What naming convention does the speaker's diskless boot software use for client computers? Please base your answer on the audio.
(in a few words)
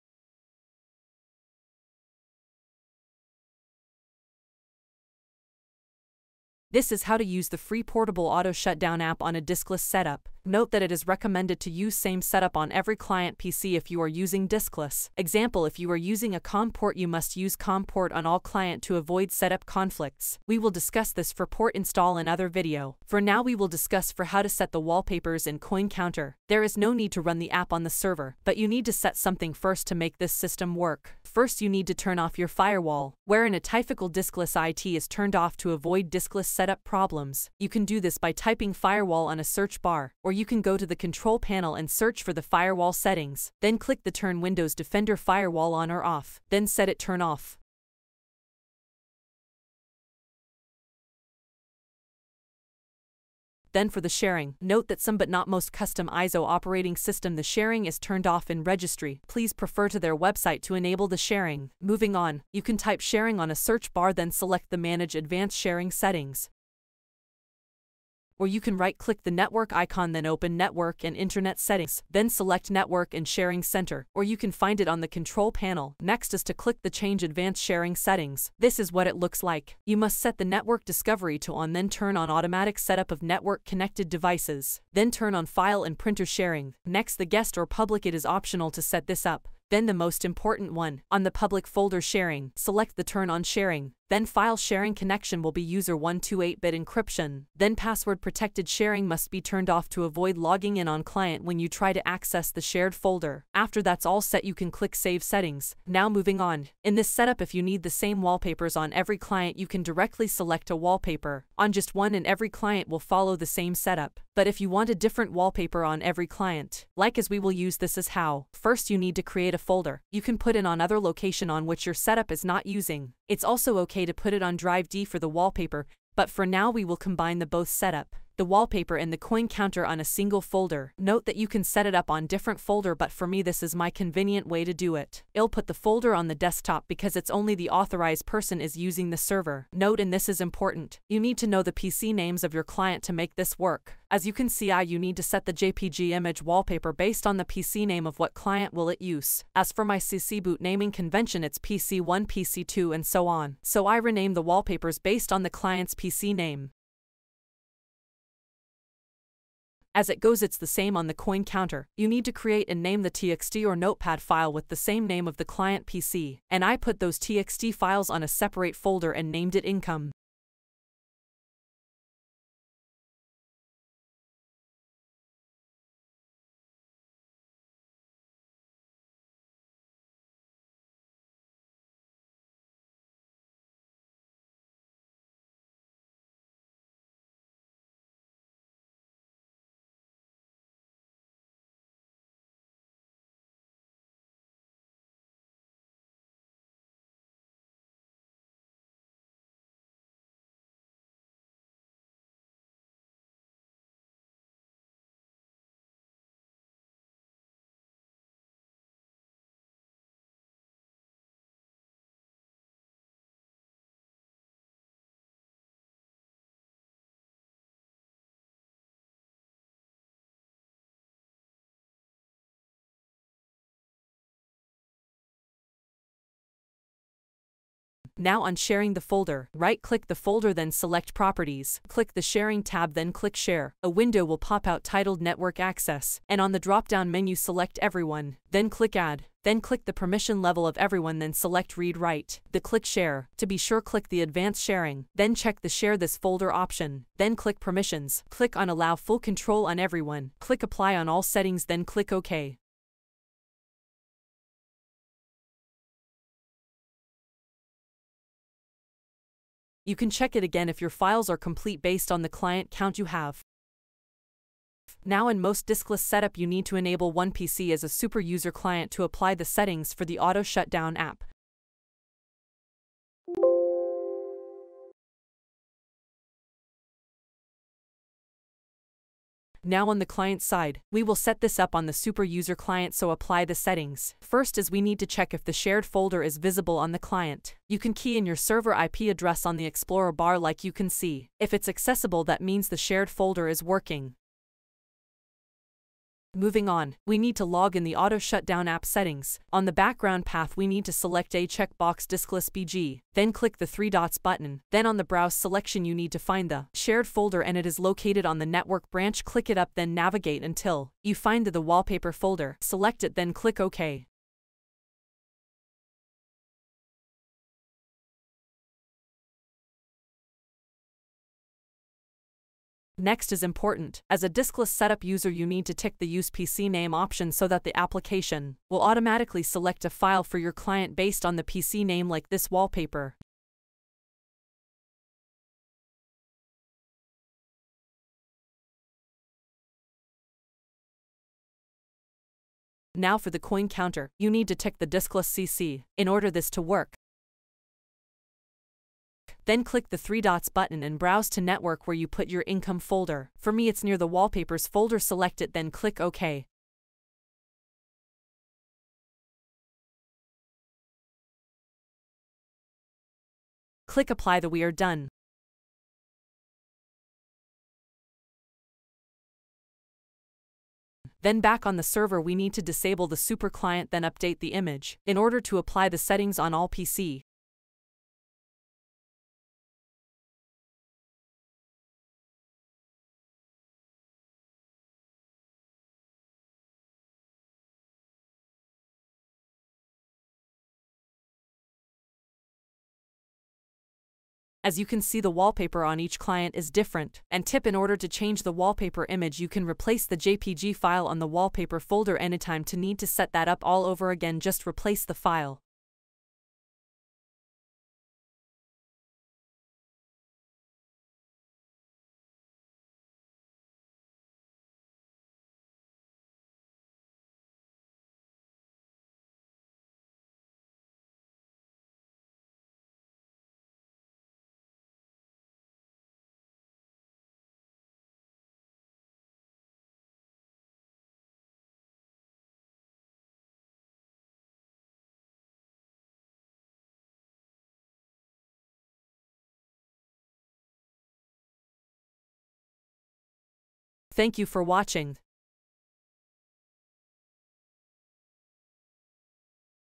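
PC1, PC2.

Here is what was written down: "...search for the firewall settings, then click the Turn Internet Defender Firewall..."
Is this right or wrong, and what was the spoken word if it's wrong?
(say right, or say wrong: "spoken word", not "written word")
wrong: "Windows", not "Internet".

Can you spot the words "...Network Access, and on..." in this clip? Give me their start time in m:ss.
3:55.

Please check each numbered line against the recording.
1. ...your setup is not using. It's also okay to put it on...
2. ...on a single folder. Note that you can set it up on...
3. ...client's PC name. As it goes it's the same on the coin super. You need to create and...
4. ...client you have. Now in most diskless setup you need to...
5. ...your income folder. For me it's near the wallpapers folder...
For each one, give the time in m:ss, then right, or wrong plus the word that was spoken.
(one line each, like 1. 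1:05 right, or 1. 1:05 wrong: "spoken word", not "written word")
1. 2:01 right
2. 2:09 right
3. 2:35 wrong: "counter", not "super"
4. 4:22 wrong: "count", not "client"
5. 5:52 right.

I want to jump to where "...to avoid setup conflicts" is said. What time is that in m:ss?
0:18.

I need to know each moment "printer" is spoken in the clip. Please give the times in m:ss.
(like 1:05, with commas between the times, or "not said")
1:25.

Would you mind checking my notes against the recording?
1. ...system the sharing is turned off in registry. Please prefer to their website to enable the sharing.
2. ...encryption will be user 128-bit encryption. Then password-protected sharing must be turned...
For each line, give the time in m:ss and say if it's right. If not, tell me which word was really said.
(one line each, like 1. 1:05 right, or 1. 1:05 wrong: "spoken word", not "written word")
1. 0:56 right
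2. 1:34 wrong: "connection", not "encryption".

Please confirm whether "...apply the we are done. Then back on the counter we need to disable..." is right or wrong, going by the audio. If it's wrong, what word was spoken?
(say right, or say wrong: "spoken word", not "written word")
wrong: "server", not "counter".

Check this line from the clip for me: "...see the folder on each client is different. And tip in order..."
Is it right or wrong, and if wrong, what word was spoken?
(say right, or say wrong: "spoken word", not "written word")
wrong: "wallpaper", not "folder".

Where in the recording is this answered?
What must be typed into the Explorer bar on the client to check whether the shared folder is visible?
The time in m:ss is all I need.
4:48.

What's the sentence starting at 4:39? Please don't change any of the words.
Now on the client side, we will set this up on the super user client so apply the settings.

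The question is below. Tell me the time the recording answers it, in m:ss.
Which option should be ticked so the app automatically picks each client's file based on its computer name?
5:26.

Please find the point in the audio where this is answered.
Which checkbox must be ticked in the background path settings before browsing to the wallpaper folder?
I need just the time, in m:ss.
5:02.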